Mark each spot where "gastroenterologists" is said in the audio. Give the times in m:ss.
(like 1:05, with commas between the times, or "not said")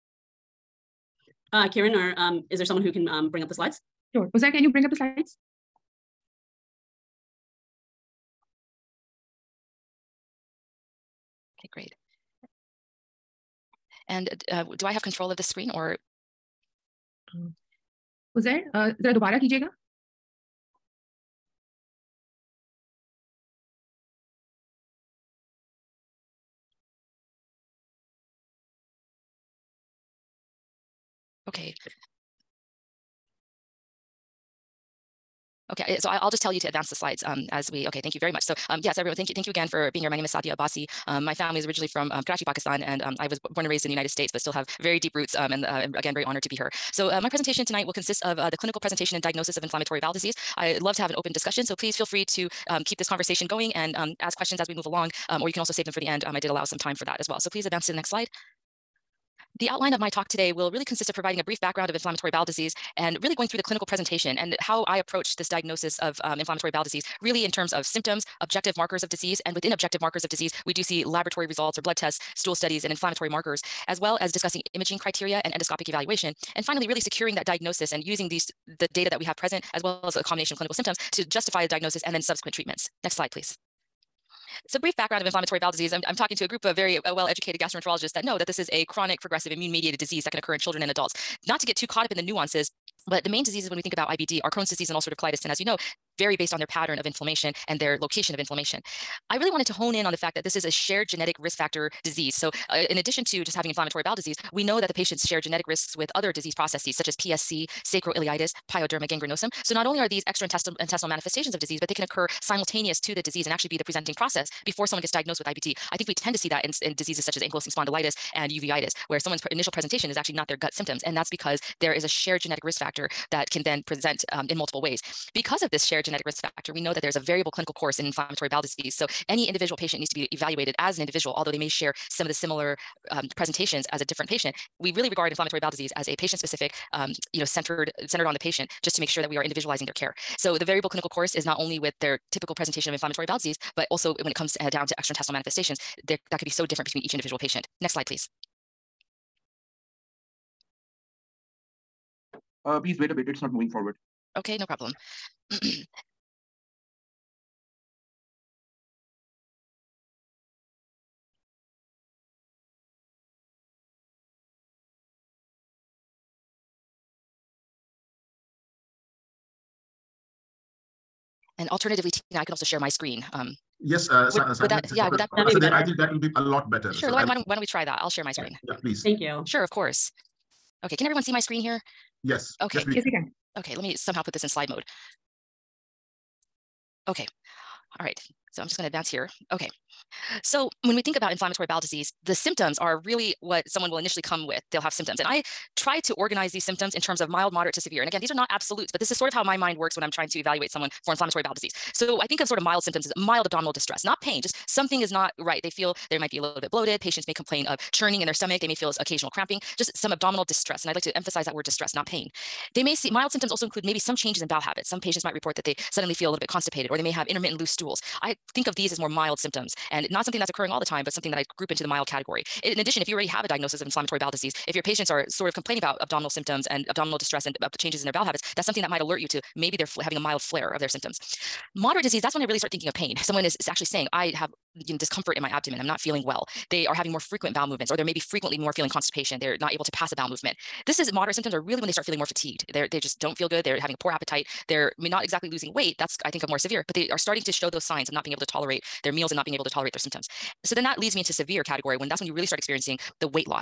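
1:27.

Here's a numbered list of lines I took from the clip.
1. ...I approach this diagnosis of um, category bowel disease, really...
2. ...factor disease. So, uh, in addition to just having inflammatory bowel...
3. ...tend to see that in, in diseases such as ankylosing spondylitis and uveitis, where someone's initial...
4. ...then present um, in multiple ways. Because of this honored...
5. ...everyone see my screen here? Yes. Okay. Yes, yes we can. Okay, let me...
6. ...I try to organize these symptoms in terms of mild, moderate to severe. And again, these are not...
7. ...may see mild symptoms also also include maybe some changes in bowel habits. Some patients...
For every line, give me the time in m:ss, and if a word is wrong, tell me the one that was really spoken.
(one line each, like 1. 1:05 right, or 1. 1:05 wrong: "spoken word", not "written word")
1. 1:04 wrong: "inflammatory", not "category"
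2. 1:41 right
3. 1:56 right
4. 2:03 wrong: "shared", not "honored"
5. 3:01 right
6. 3:15 right
7. 3:32 right.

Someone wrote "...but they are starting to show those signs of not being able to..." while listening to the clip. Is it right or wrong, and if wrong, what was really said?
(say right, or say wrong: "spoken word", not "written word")
right.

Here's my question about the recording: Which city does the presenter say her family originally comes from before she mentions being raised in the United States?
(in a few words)
Karachi.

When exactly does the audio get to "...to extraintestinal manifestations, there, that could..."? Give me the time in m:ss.
2:24.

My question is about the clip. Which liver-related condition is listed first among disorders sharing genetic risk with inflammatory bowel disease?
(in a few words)
PSC.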